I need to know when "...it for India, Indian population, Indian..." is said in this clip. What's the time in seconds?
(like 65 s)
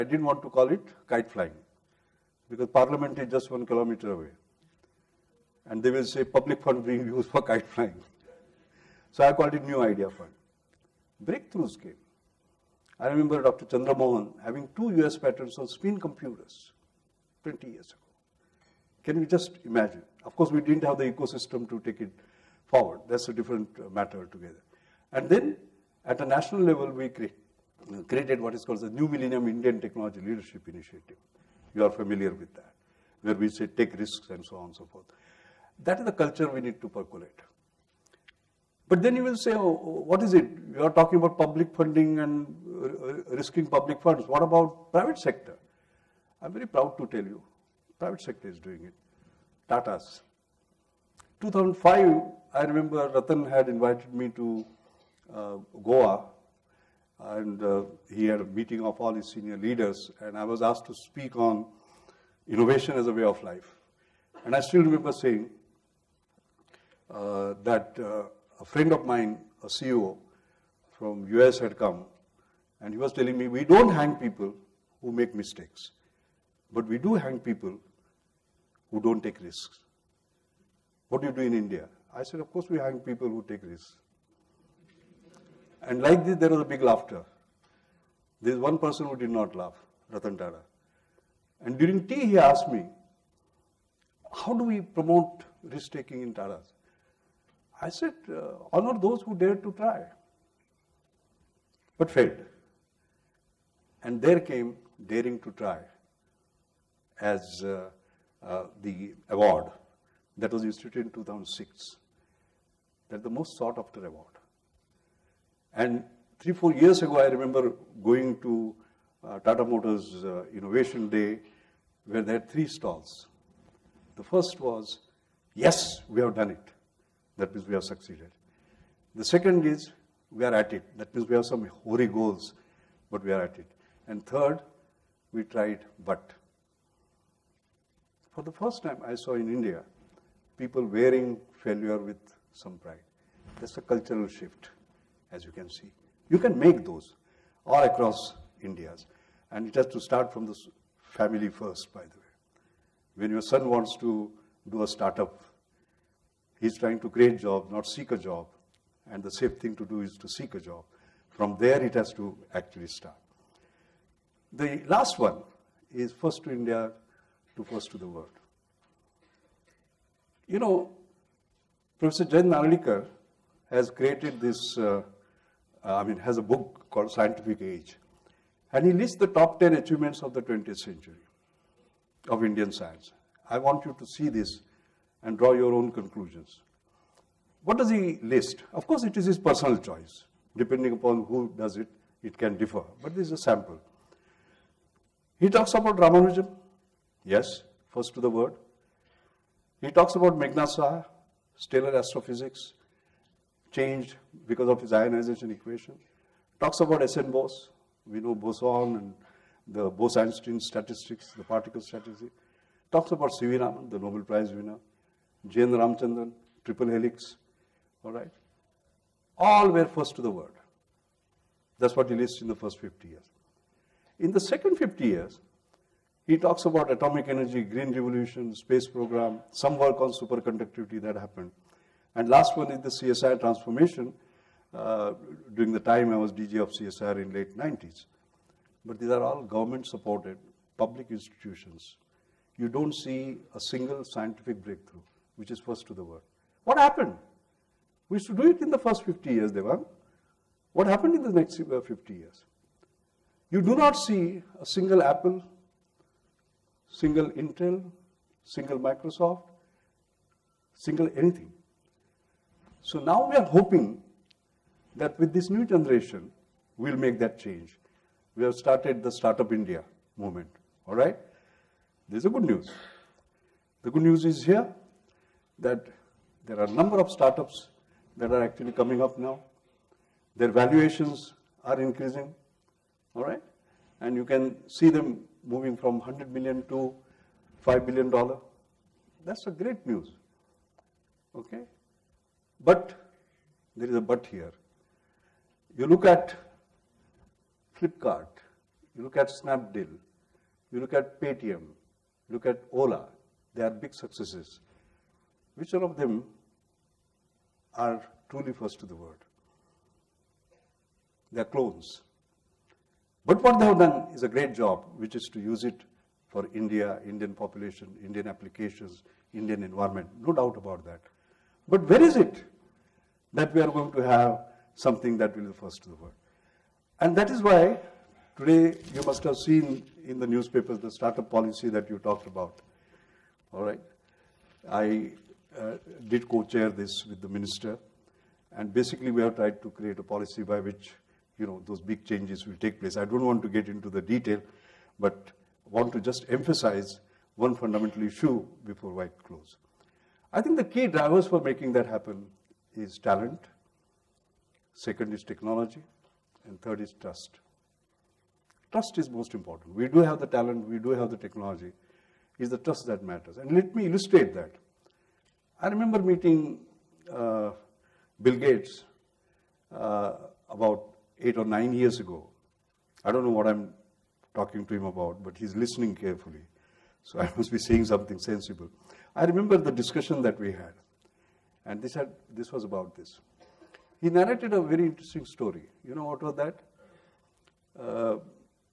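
315 s.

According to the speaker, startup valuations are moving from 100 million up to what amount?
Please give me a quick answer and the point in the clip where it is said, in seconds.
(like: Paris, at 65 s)
$5 billion, at 287 s.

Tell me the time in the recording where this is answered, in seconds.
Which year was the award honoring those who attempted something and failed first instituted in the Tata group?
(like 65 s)
111 s.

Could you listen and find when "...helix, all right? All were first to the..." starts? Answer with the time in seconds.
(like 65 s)
216 s.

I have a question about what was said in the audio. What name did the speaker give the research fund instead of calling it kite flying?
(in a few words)
New Idea Fund.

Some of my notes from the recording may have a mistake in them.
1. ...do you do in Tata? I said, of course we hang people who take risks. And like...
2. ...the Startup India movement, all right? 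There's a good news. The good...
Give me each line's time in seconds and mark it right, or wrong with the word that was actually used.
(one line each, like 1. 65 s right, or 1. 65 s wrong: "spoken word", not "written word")
1. 81 s wrong: "India", not "Tata"
2. 269 s right.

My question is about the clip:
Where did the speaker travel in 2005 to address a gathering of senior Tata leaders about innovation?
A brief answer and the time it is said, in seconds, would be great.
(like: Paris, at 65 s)
Goa, at 55 s.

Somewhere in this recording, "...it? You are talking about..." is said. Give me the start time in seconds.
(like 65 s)
40 s.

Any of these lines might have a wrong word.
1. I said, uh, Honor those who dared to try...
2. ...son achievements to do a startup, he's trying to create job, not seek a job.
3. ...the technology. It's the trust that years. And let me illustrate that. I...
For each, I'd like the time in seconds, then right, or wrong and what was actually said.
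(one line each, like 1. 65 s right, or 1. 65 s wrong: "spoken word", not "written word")
1. 97 s right
2. 153 s wrong: "wants", not "achievements"
3. 361 s wrong: "matters", not "years".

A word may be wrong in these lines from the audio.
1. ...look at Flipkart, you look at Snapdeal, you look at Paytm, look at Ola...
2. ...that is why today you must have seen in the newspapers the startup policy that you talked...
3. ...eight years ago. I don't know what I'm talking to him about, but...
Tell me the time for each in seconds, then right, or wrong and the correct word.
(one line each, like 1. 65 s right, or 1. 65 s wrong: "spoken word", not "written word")
1. 295 s right
2. 327 s right
3. 371 s wrong: "nine", not "eight".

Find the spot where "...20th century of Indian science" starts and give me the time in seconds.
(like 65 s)
180 s.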